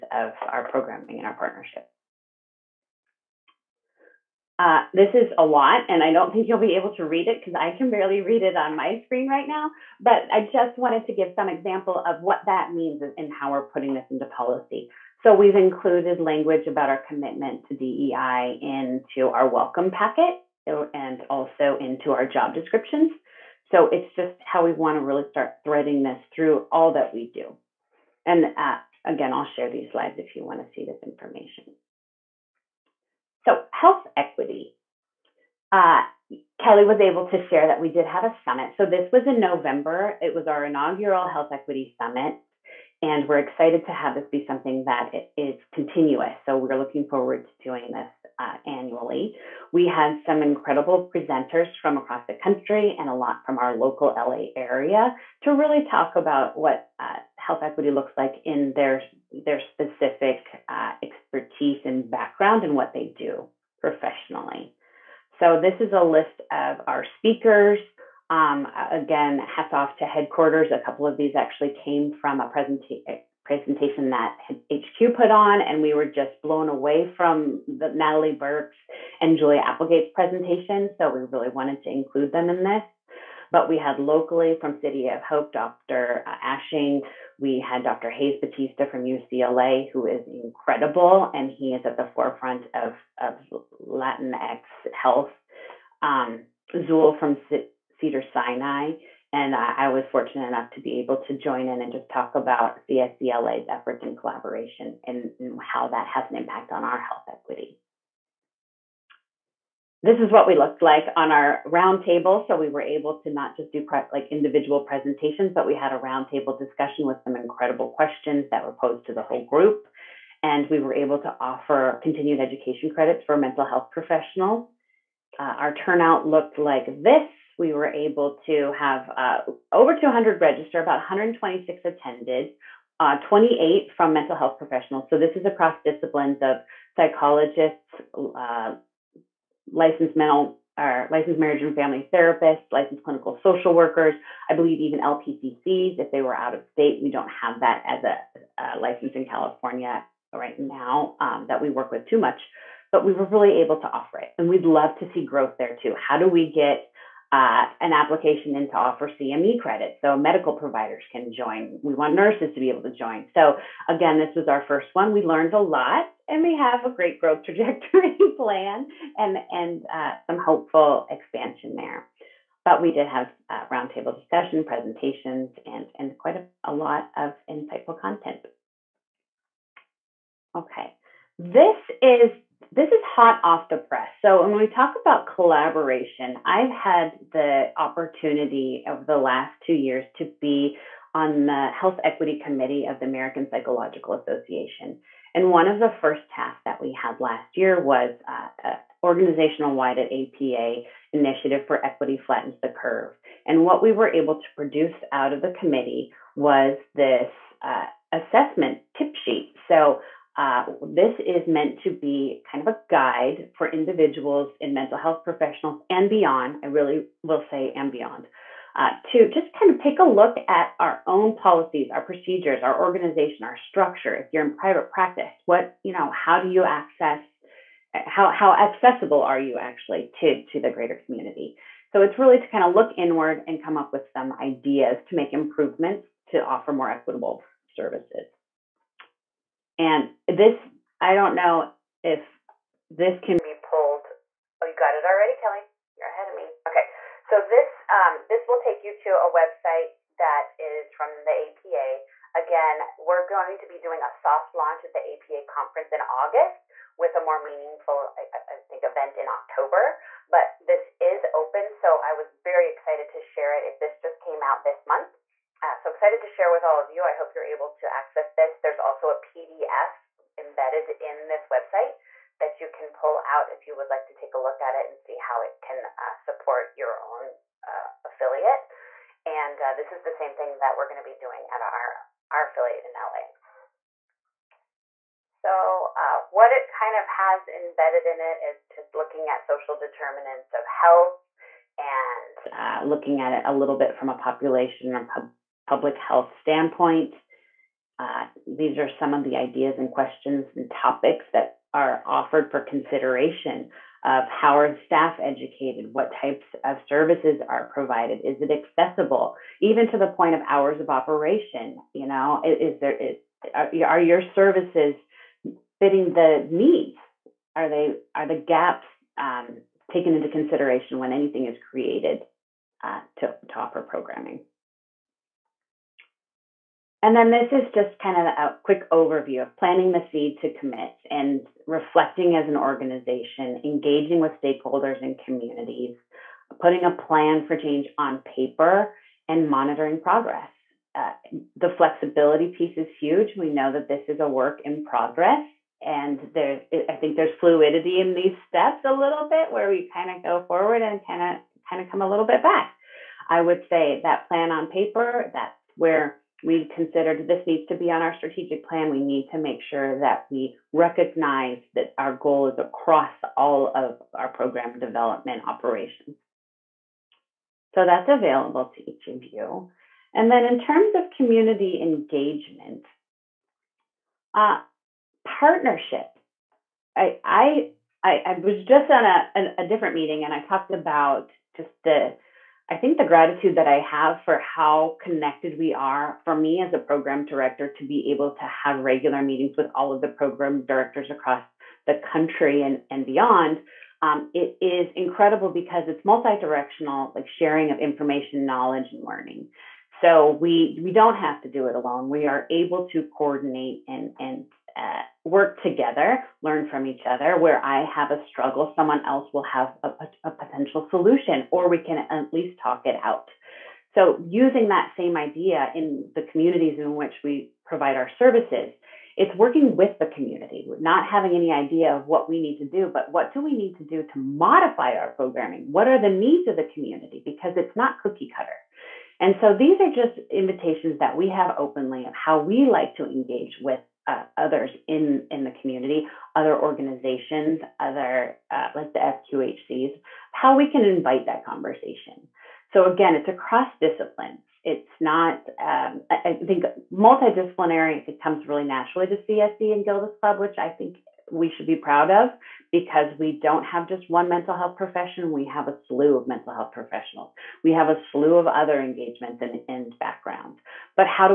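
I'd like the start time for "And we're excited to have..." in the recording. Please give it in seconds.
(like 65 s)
42 s.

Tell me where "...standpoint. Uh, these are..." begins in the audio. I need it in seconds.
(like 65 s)
296 s.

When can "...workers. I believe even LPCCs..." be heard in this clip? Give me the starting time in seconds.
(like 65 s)
143 s.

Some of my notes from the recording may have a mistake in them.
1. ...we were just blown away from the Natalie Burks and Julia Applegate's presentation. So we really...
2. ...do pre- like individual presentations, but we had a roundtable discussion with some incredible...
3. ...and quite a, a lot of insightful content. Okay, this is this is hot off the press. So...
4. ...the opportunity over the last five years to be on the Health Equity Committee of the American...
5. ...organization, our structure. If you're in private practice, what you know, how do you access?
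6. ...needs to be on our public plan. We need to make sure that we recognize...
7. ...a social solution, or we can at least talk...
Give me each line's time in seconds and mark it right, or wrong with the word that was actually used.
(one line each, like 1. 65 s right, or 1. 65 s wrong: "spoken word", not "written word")
1. 75 s right
2. 113 s right
3. 175 s right
4. 187 s wrong: "two", not "five"
5. 222 s right
6. 357 s wrong: "strategic", not "public"
7. 410 s wrong: "potential", not "social".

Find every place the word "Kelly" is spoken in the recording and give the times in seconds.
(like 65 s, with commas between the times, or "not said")
36 s, 245 s.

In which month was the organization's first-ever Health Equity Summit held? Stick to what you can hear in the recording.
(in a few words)
November.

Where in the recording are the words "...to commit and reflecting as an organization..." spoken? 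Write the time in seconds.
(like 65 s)
330 s.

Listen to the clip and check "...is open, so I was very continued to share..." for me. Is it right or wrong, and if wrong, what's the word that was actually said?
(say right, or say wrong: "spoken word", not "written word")
wrong: "excited", not "continued".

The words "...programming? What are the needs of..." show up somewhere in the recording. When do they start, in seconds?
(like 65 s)
425 s.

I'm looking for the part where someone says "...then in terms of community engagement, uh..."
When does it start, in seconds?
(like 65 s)
370 s.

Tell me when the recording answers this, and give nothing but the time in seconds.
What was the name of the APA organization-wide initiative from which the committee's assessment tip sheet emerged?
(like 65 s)
201 s.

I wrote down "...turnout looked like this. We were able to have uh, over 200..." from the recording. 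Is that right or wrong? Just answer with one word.
right.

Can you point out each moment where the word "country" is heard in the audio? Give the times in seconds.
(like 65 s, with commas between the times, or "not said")
52 s, 392 s.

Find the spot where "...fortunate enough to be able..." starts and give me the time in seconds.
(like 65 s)
100 s.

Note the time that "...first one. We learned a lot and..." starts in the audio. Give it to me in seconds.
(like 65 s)
164 s.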